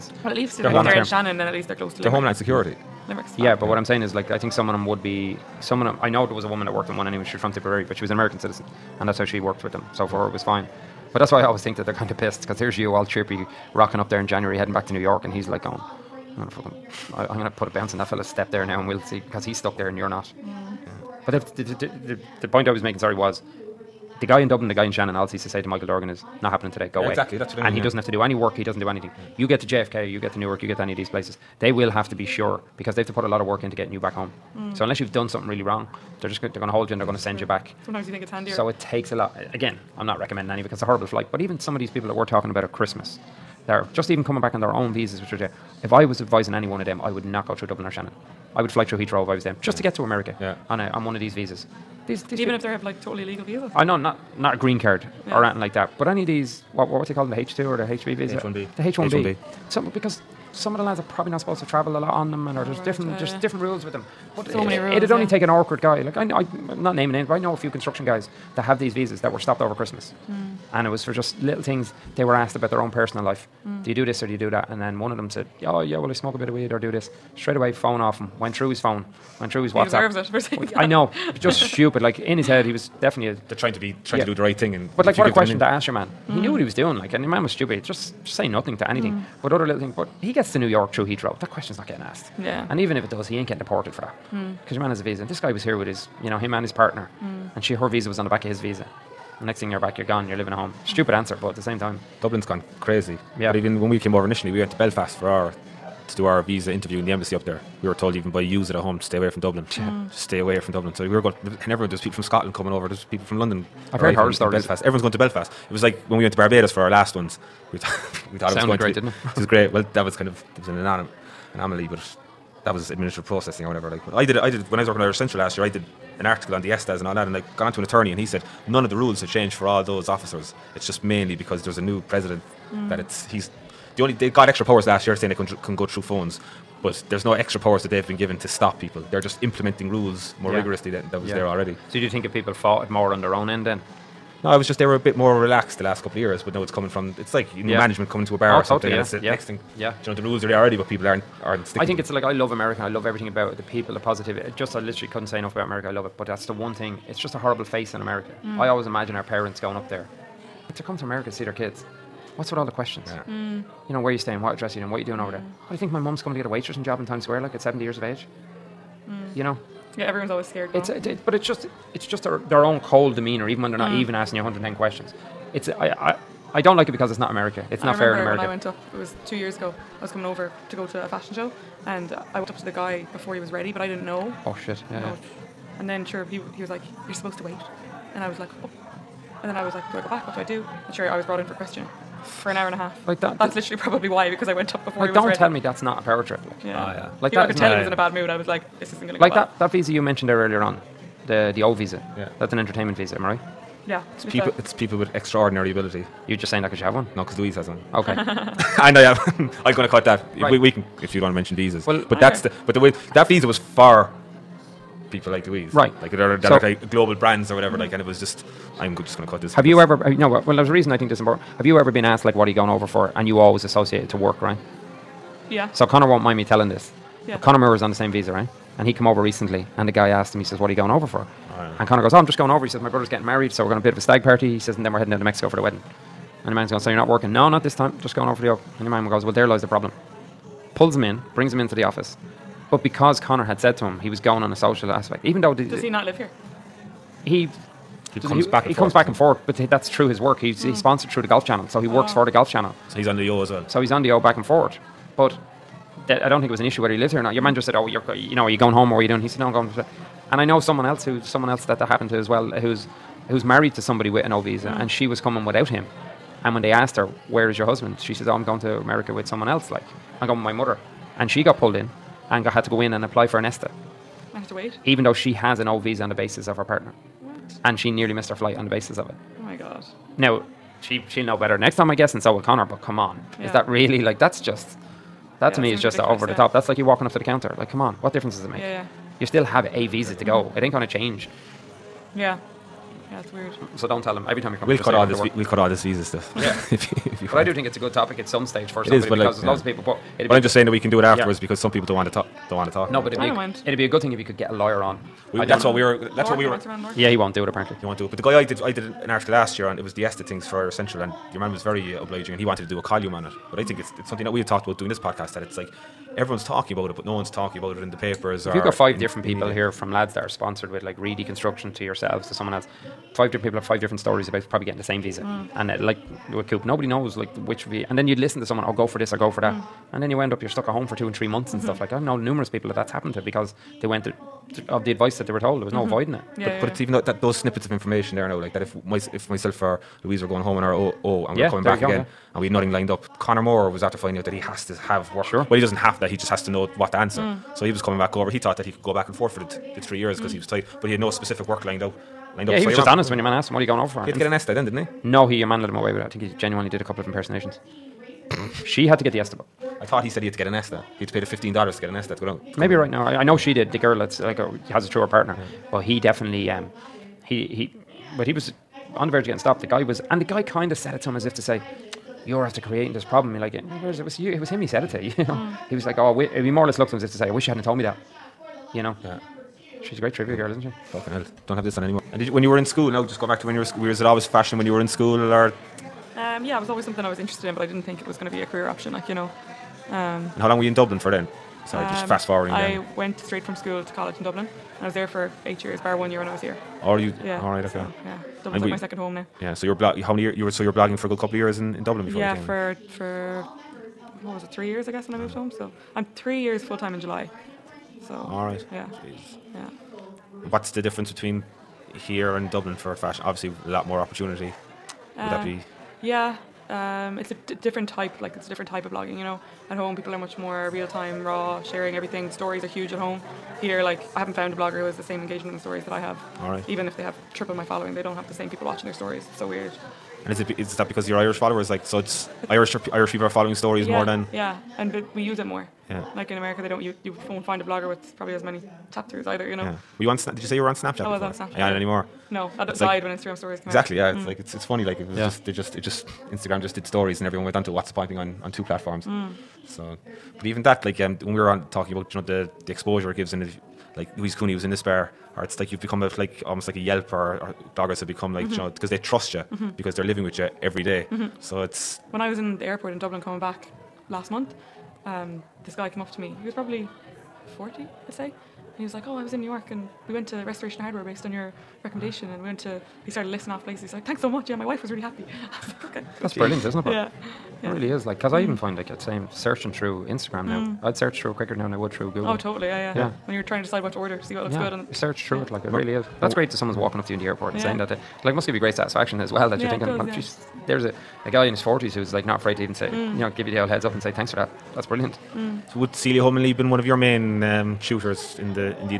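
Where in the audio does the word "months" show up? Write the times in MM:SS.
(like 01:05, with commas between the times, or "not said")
05:31, 07:44.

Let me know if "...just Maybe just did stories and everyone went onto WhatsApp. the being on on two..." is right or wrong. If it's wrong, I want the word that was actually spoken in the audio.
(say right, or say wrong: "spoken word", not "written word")
wrong: "Instagram", not "Maybe".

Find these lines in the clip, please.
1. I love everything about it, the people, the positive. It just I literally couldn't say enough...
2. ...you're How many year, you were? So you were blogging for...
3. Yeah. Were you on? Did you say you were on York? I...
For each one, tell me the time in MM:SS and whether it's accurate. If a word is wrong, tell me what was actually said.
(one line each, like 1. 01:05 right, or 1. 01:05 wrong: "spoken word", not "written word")
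1. 02:32 right
2. 06:39 right
3. 07:19 wrong: "Snapchat", not "York".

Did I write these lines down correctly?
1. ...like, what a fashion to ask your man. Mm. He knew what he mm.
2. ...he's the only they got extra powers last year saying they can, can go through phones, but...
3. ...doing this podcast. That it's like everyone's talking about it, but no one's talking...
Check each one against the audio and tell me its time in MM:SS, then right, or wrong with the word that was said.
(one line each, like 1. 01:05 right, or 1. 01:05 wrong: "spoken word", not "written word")
1. 01:25 wrong: "question", not "fashion"
2. 02:13 right
3. 05:14 right.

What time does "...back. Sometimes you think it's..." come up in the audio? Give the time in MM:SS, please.
00:37.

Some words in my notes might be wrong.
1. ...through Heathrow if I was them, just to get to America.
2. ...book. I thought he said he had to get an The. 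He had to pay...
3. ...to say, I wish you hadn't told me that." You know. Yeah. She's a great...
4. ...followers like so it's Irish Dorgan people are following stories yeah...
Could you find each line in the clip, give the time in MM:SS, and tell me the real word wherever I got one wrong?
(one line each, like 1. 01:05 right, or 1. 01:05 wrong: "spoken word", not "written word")
1. 00:48 right
2. 05:59 wrong: "ESTA", not "The"
3. 06:17 right
4. 07:11 wrong: "Irish", not "Dorgan".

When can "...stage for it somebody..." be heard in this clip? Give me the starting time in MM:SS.
04:58.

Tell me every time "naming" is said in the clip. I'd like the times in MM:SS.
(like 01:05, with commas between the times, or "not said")
01:06.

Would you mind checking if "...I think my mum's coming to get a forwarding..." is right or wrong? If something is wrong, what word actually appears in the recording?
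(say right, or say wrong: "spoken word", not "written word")
wrong: "waitressing", not "forwarding".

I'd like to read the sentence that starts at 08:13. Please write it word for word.
you know, give you the old heads up and say thanks for that.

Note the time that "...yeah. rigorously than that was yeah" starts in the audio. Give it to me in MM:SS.
02:20.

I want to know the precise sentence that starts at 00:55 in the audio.
or anything like that, but any of these what, what do you call them?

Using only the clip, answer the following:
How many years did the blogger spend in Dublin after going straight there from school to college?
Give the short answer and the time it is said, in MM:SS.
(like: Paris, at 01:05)
8, at 06:35.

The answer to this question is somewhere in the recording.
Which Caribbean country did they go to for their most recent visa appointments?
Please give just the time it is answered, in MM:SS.
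01:56.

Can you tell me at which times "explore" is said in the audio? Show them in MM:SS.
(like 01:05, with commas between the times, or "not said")
not said.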